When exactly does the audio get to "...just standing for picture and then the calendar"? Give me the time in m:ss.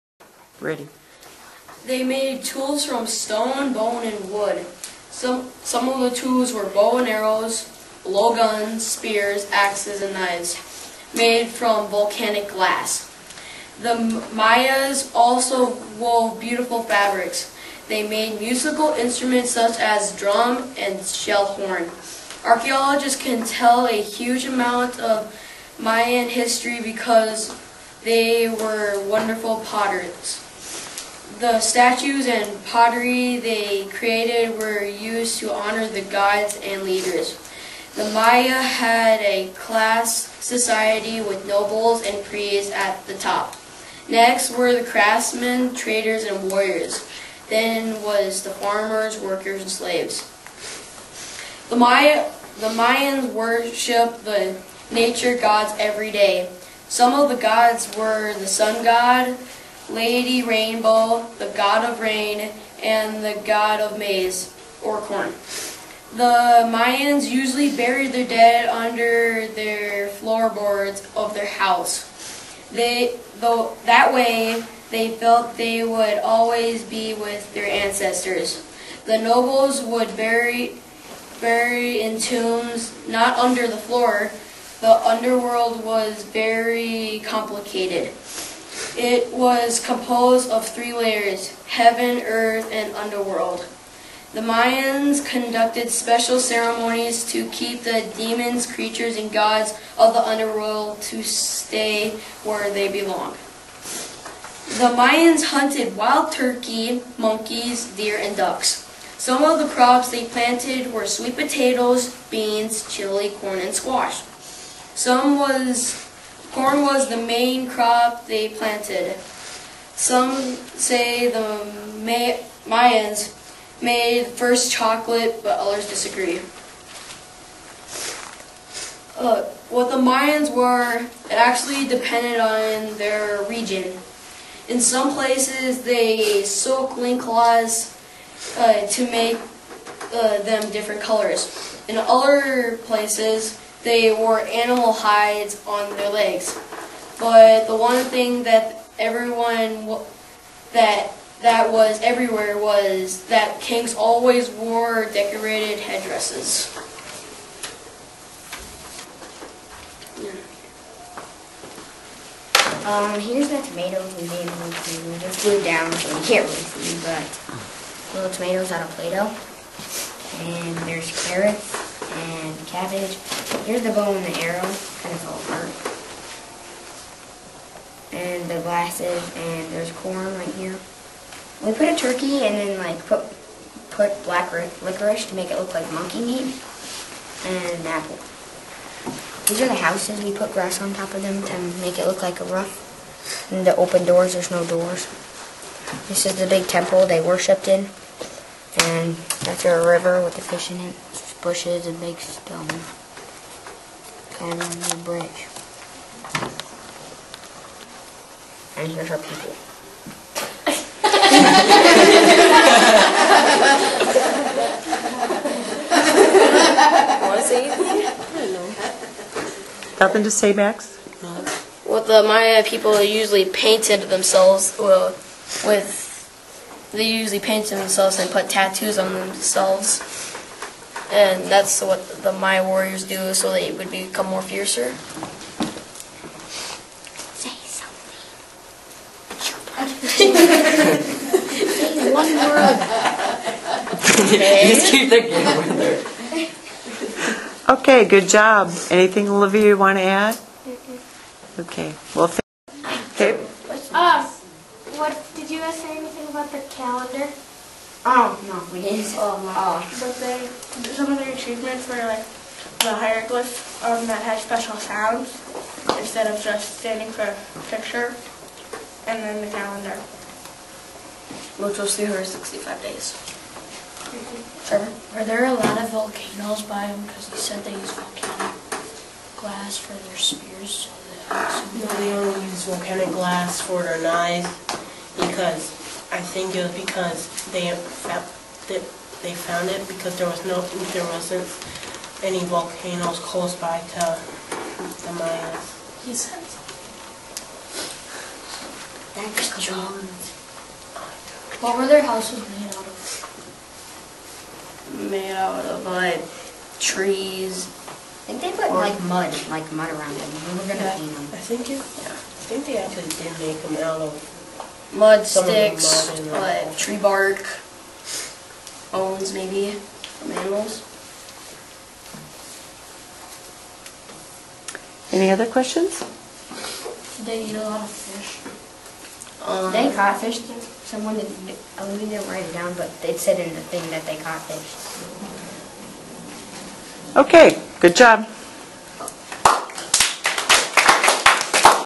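4:26.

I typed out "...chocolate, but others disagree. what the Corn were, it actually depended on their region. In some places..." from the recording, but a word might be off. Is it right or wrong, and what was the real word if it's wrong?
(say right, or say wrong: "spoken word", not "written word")
wrong: "Mayans", not "Corn".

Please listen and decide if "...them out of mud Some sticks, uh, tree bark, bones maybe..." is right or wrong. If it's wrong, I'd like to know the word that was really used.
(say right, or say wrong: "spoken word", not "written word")
right.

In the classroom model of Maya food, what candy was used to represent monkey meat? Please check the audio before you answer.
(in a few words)
Black licorice.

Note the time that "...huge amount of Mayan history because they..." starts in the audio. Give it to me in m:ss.
0:24.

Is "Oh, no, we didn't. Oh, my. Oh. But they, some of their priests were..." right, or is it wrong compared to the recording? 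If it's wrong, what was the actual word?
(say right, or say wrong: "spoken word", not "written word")
wrong: "achievements", not "priests".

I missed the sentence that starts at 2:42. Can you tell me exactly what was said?
Um, here's my tomato we made Just glued down so you can't really see, but little tomatoes out of Play-Doh.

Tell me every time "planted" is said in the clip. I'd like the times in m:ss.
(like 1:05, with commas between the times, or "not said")
1:50, 1:58.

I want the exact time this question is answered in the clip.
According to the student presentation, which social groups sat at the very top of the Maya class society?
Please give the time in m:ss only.
0:41.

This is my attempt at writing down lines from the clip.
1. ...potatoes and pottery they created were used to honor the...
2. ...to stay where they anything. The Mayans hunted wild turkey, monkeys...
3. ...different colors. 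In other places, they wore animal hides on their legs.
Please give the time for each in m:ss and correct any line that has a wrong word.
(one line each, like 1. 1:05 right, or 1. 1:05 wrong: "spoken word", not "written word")
1. 0:31 wrong: "statues", not "potatoes"
2. 1:41 wrong: "belong", not "anything"
3. 2:20 right.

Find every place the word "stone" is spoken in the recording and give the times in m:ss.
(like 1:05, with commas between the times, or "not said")
0:03, 3:22.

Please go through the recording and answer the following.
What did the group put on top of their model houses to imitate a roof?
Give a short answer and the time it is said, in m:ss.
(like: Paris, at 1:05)
Grass, at 3:10.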